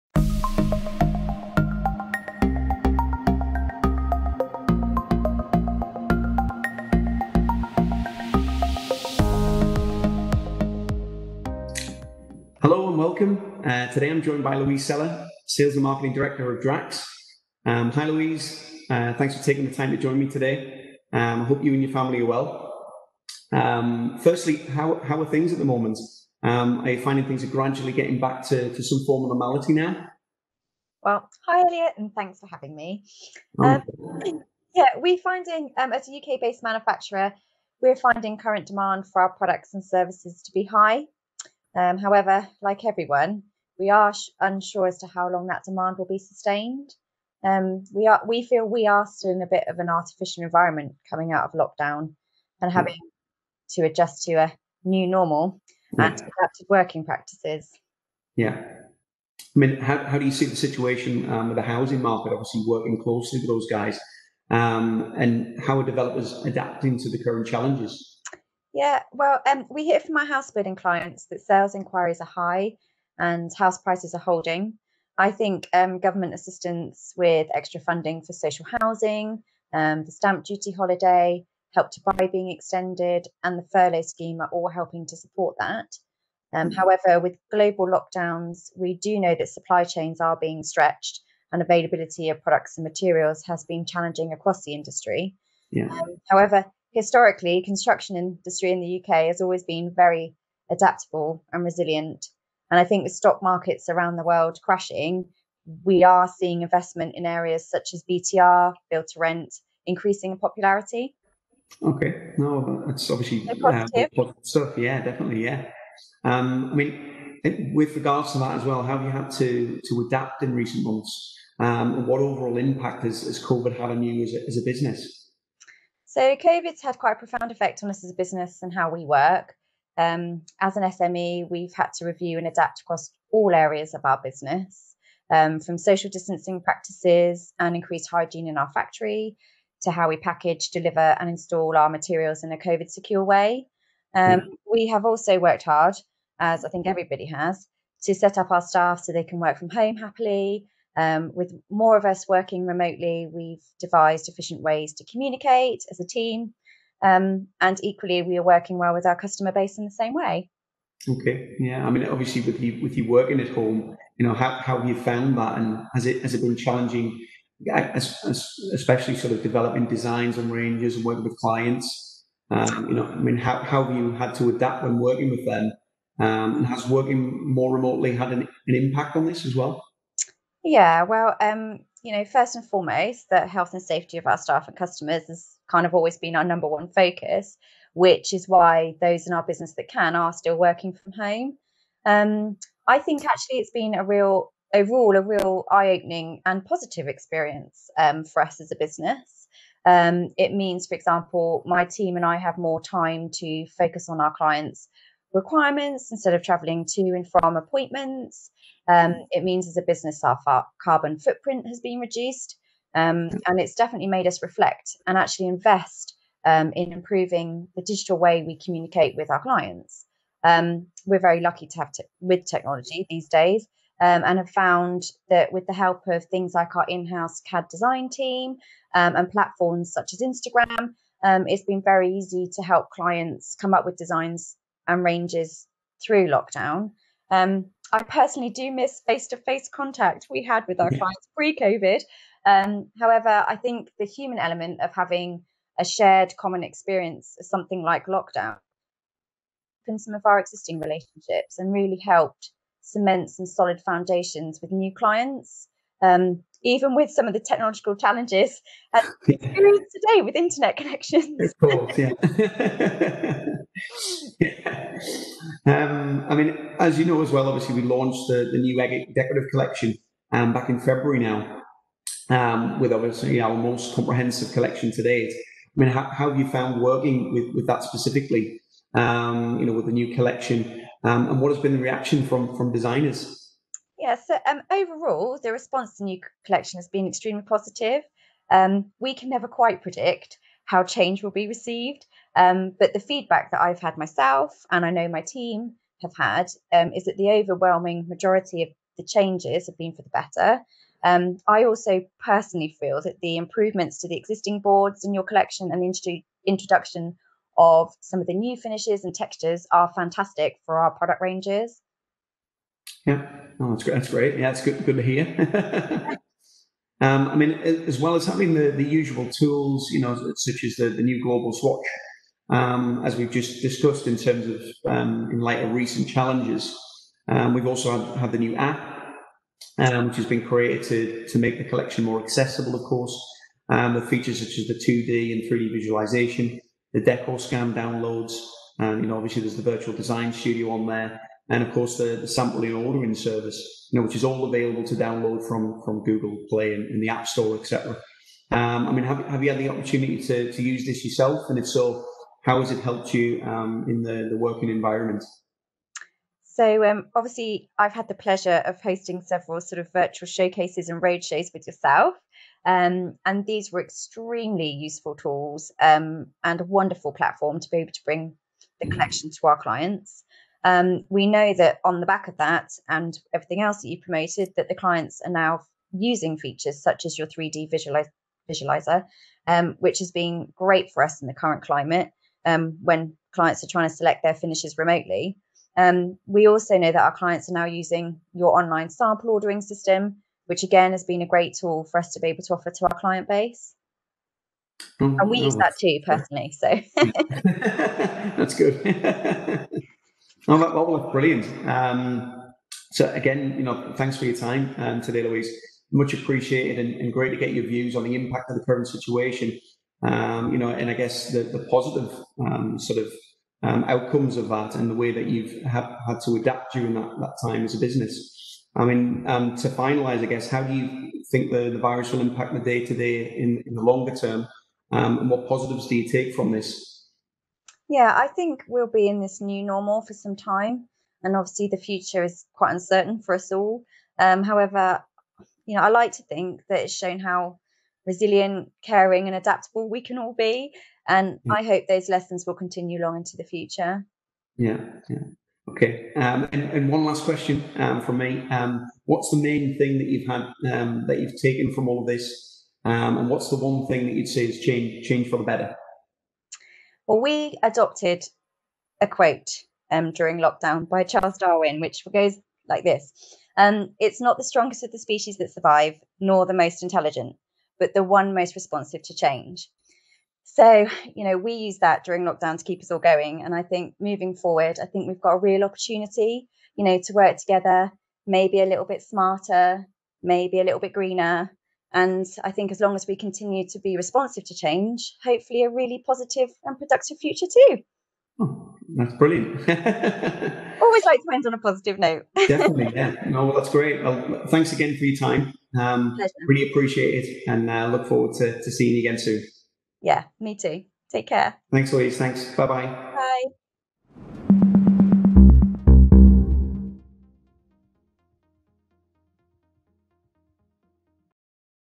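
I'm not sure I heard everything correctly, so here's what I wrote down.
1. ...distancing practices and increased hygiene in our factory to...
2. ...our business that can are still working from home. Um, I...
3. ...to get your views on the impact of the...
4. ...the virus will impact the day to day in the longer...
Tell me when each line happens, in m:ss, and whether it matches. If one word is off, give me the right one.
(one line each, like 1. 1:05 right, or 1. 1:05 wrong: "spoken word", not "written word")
1. 2:16 right
2. 3:09 right
3. 6:47 right
4. 7:01 right.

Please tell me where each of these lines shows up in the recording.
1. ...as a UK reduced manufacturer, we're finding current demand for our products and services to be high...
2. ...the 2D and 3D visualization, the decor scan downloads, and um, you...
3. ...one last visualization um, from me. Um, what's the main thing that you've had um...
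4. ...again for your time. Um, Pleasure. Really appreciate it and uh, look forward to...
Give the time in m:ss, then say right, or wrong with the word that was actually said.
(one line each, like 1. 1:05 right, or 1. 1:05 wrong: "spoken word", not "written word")
1. 0:35 wrong: "based", not "reduced"
2. 5:34 right
3. 7:26 wrong: "question", not "visualization"
4. 8:14 right.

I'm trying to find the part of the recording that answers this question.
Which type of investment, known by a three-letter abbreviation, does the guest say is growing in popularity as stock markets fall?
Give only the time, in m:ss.
1:48.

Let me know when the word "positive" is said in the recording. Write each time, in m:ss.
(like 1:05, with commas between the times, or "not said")
3:16, 4:47, 6:51, 7:05, 8:06, 8:11.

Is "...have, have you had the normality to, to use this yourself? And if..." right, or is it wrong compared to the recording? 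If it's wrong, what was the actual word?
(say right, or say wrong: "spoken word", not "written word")
wrong: "opportunity", not "normality".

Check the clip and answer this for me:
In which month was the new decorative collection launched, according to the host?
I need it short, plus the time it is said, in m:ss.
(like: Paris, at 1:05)
February, at 4:30.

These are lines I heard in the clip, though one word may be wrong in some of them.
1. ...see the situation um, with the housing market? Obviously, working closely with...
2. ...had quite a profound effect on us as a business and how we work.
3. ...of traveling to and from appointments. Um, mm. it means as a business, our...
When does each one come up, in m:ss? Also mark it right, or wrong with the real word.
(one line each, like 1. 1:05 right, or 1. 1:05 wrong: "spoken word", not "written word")
1. 1:00 right
2. 2:06 right
3. 3:26 right.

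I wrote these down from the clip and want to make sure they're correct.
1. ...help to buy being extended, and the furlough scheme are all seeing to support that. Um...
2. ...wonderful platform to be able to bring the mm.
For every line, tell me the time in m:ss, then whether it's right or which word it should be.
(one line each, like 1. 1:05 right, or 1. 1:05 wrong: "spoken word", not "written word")
1. 1:21 wrong: "helping", not "seeing"
2. 6:06 right.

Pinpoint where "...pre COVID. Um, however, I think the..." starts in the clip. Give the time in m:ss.
4:01.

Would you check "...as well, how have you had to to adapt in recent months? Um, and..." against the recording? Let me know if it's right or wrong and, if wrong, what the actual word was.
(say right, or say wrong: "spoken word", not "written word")
right.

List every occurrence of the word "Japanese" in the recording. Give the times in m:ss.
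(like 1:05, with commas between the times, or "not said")
not said.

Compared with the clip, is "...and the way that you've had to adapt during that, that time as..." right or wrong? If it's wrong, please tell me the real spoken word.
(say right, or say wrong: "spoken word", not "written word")
right.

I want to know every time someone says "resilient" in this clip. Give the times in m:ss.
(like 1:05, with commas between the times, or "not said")
1:41, 7:18.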